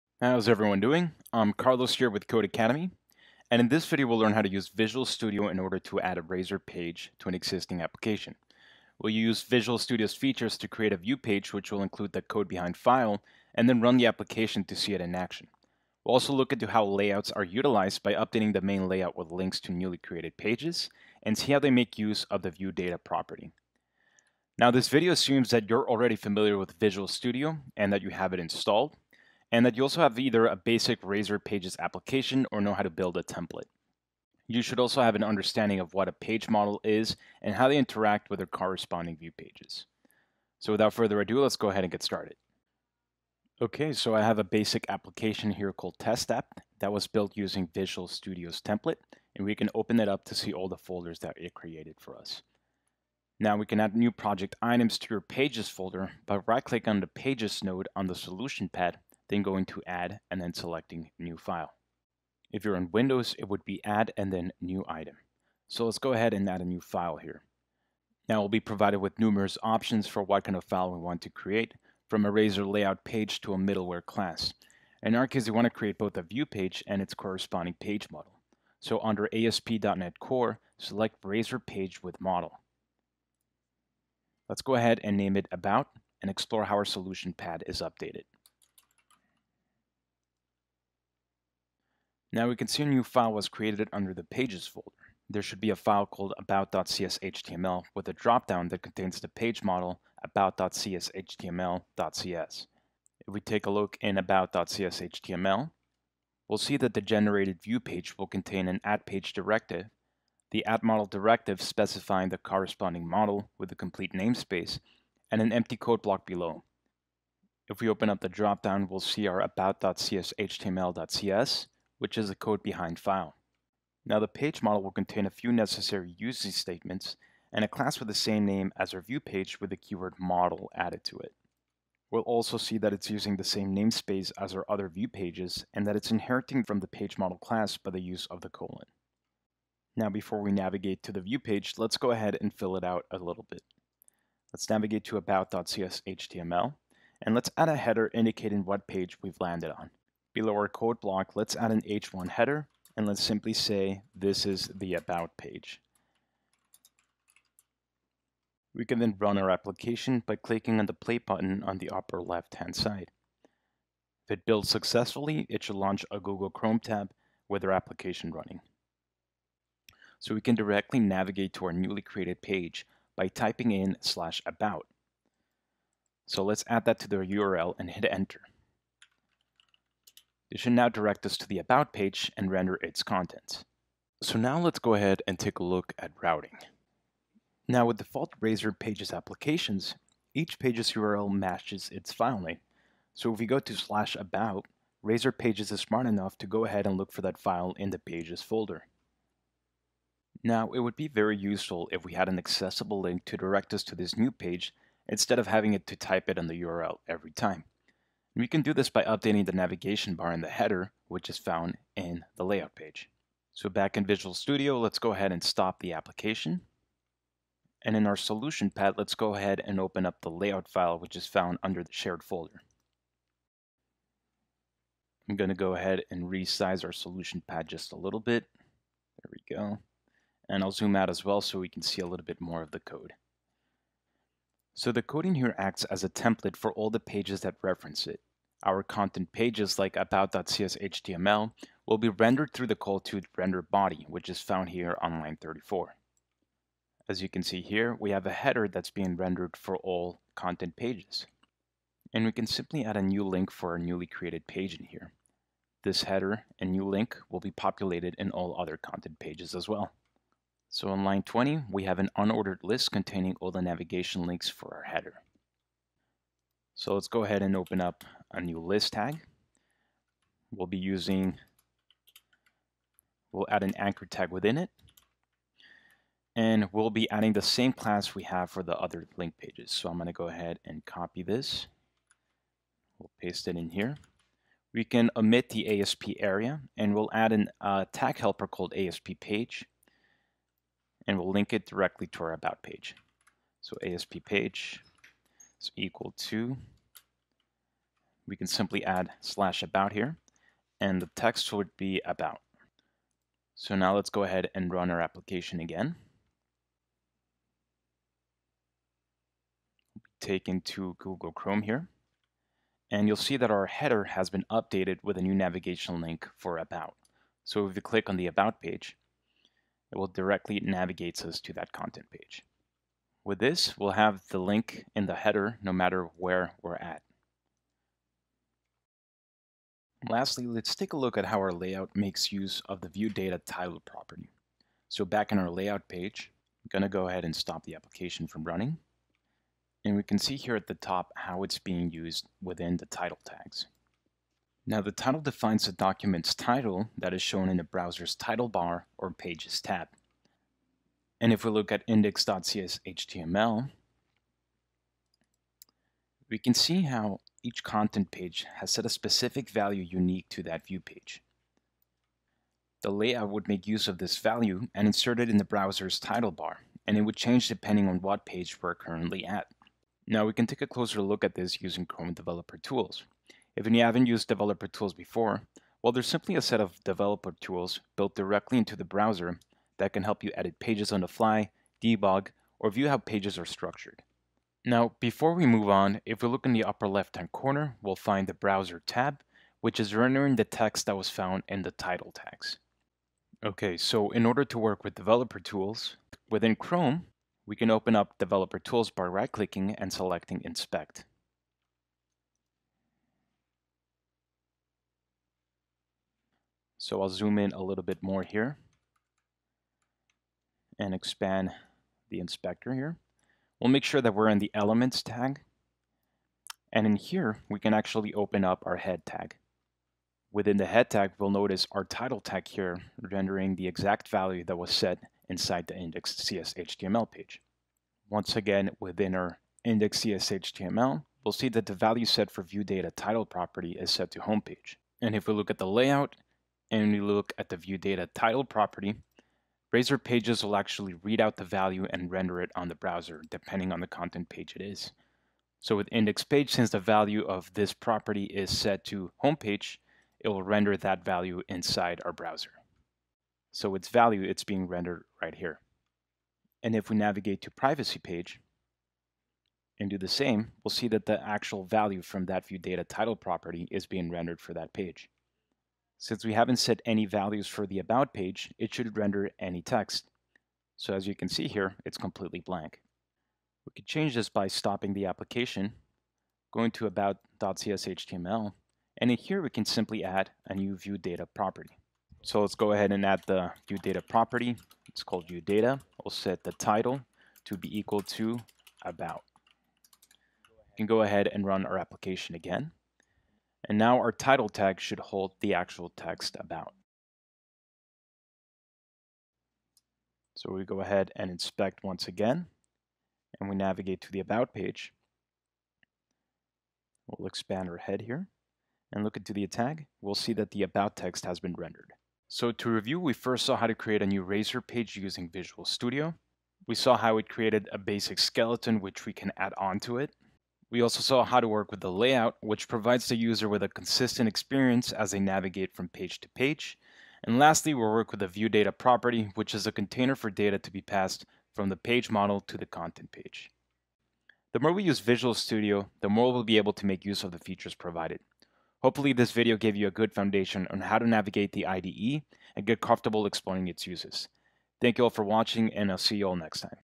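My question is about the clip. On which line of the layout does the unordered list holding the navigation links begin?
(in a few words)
20.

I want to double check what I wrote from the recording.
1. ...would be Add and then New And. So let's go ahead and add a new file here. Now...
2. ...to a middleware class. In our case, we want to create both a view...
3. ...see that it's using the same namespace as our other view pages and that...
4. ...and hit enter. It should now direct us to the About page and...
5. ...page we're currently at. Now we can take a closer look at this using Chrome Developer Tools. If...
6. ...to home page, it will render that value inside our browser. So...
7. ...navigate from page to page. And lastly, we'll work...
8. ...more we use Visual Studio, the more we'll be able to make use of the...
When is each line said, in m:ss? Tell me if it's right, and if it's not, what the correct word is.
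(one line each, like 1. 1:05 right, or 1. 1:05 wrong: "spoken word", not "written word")
1. 1:03 wrong: "Item", not "And"
2. 1:13 right
3. 2:12 right
4. 2:57 right
5. 6:08 right
6. 7:28 right
7. 8:45 right
8. 8:54 right.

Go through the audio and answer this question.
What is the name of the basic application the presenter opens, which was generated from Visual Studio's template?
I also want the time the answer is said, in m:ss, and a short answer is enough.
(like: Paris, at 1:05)
Test App, at 0:45.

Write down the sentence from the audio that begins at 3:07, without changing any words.
Now with default Razor Pages applications, each page's URL matches its file name.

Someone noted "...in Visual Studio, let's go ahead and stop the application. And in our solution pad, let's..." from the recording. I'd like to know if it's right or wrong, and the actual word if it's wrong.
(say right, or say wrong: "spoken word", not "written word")
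right.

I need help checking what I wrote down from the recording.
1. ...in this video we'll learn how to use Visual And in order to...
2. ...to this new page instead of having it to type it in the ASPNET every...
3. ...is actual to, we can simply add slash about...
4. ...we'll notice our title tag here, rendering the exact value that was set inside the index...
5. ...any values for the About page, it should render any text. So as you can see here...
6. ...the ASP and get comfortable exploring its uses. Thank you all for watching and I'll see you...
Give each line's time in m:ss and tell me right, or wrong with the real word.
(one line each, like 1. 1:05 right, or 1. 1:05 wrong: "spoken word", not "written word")
1. 0:03 wrong: "Studio", not "And"
2. 3:23 wrong: "URL", not "ASPNET"
3. 4:55 wrong: "equal", not "actual"
4. 7:01 right
5. 7:46 right
6. 9:01 wrong: "IDE", not "ASP".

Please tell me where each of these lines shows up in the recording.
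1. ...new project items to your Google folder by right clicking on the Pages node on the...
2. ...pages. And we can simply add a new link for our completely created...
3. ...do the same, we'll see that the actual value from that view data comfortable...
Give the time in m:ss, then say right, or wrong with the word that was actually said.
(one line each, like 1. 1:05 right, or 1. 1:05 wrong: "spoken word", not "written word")
1. 0:53 wrong: "Pages", not "Google"
2. 4:10 wrong: "newly", not "completely"
3. 7:39 wrong: "title", not "comfortable".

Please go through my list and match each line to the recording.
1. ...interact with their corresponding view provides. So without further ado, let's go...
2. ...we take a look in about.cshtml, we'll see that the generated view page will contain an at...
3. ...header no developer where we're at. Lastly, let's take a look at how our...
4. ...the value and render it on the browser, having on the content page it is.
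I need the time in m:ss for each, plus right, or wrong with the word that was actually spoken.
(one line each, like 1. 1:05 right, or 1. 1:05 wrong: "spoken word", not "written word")
1. 0:37 wrong: "pages", not "provides"
2. 1:43 right
3. 5:25 wrong: "matter", not "developer"
4. 7:21 wrong: "depending", not "having".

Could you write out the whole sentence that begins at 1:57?
If we open up the dropdown, we'll see our about.cshtml.cs, which is the code behind file.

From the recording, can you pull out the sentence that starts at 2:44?
If it builds successfully, it should launch a Google Chrome tab with our application running.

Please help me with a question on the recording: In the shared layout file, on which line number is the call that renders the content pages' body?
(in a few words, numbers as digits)
34.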